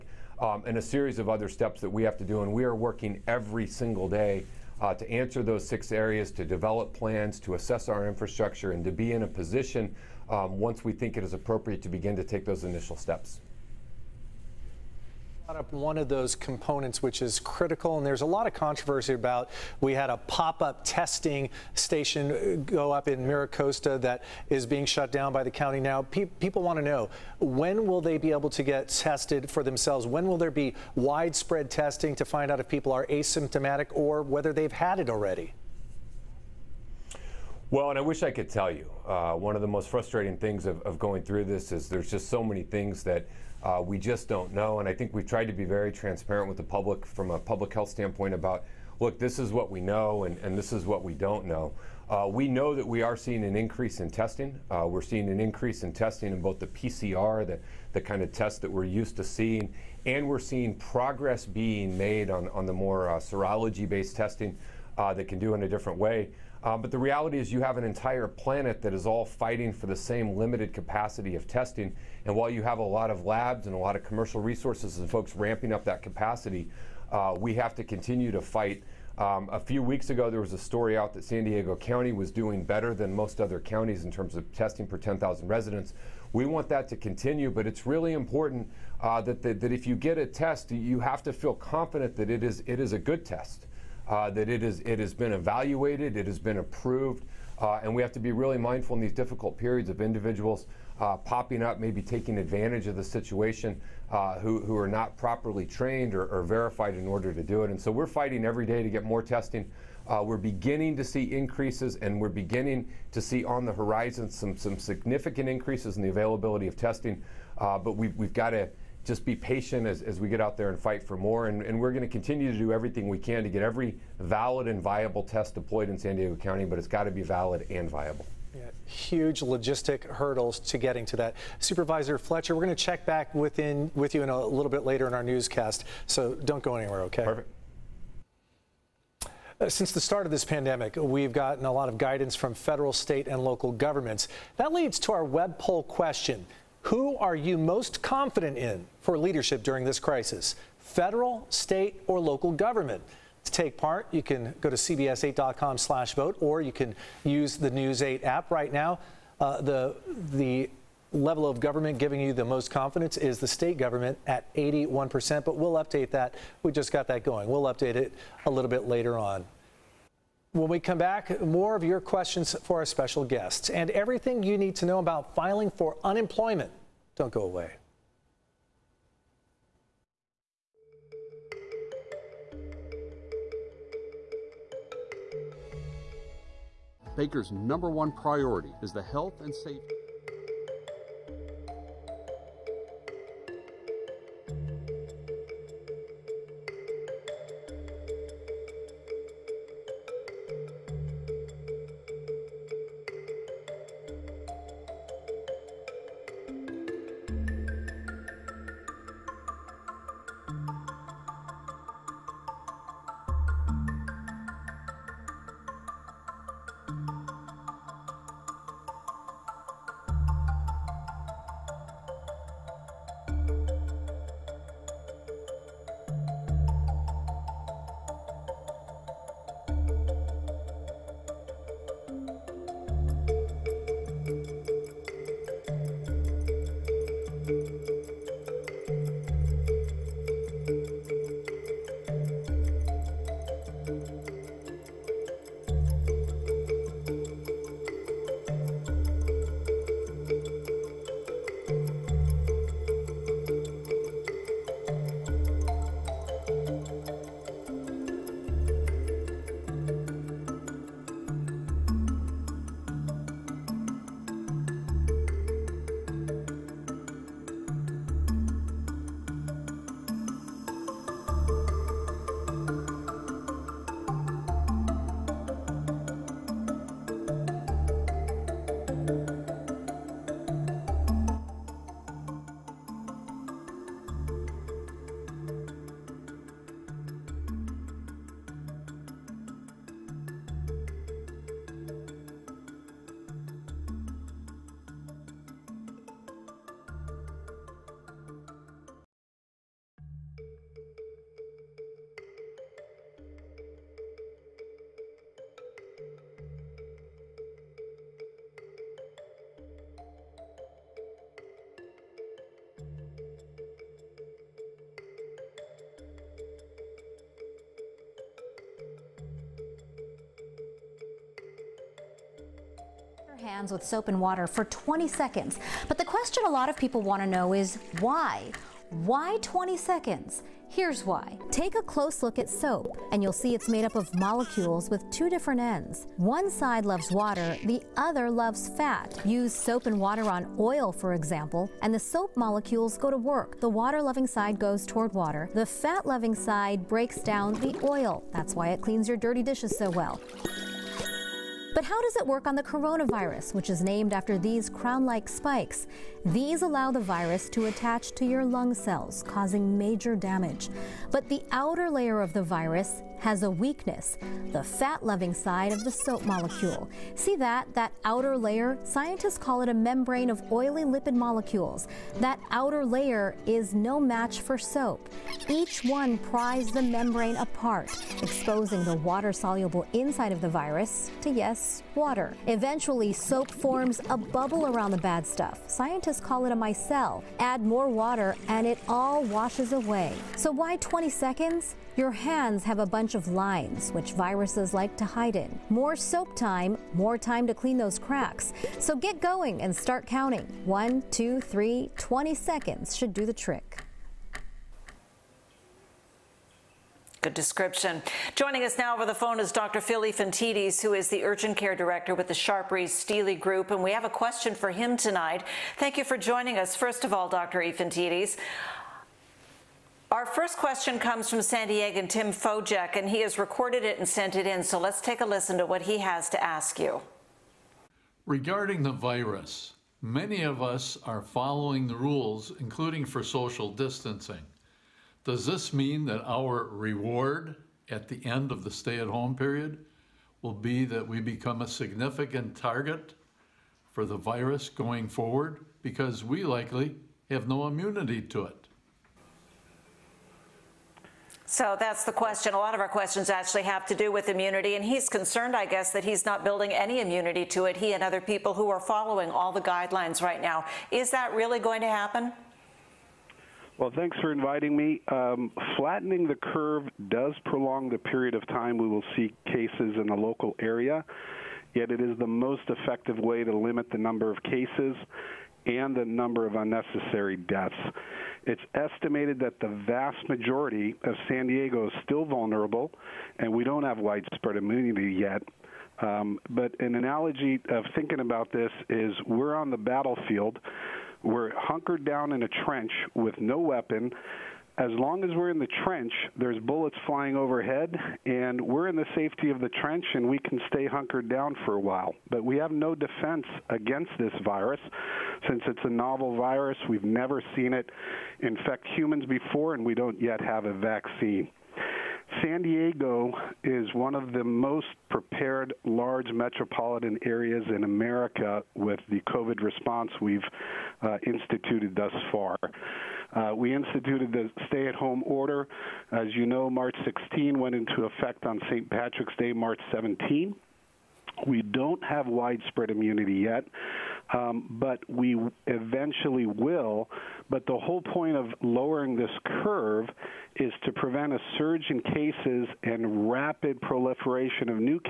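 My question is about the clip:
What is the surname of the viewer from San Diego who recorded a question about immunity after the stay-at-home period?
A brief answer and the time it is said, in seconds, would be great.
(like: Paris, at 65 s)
Fojek, at 422 s.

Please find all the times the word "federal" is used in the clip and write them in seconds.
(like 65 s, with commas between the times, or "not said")
142 s, 150 s.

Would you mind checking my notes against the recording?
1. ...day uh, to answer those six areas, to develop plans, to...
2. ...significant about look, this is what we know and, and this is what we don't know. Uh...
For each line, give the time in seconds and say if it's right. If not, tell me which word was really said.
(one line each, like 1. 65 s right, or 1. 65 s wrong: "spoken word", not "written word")
1. 4 s right
2. 47 s wrong: "standpoint", not "significant".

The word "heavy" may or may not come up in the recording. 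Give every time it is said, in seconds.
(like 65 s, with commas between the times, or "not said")
not said.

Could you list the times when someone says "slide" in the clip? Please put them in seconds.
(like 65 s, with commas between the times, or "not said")
not said.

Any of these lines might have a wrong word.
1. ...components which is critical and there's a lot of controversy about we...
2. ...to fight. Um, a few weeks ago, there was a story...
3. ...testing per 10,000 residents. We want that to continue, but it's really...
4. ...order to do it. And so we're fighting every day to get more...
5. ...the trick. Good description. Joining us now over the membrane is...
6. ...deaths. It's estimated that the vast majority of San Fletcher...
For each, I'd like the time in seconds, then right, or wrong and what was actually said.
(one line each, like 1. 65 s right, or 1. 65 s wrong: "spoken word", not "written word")
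1. 16 s right
2. 78 s right
3. 84 s right
4. 107 s right
5. 403 s wrong: "phone", not "membrane"
6. 477 s wrong: "Diego", not "Fletcher".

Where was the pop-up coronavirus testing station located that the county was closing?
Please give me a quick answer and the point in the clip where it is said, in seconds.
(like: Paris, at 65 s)
Miracosta, at 23 s.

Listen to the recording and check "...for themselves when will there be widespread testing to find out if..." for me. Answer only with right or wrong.
right.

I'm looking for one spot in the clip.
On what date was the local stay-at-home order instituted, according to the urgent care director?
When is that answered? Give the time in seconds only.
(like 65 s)
526 s.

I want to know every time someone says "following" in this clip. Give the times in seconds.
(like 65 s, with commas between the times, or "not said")
431 s, 458 s.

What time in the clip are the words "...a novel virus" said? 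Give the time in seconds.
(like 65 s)
505 s.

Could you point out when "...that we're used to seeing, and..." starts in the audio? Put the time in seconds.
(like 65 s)
58 s.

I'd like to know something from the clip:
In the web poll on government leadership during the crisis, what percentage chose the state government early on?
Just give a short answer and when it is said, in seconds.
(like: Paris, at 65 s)
81%, at 164 s.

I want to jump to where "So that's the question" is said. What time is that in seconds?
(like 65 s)
451 s.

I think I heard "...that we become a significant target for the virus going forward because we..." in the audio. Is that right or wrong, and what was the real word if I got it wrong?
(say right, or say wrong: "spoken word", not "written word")
right.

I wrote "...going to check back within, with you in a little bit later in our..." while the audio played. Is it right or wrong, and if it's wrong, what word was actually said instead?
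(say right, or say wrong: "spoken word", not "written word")
right.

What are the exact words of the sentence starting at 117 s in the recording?
Uh, but we, we've got to just be patient as, as we get out there and fight for more.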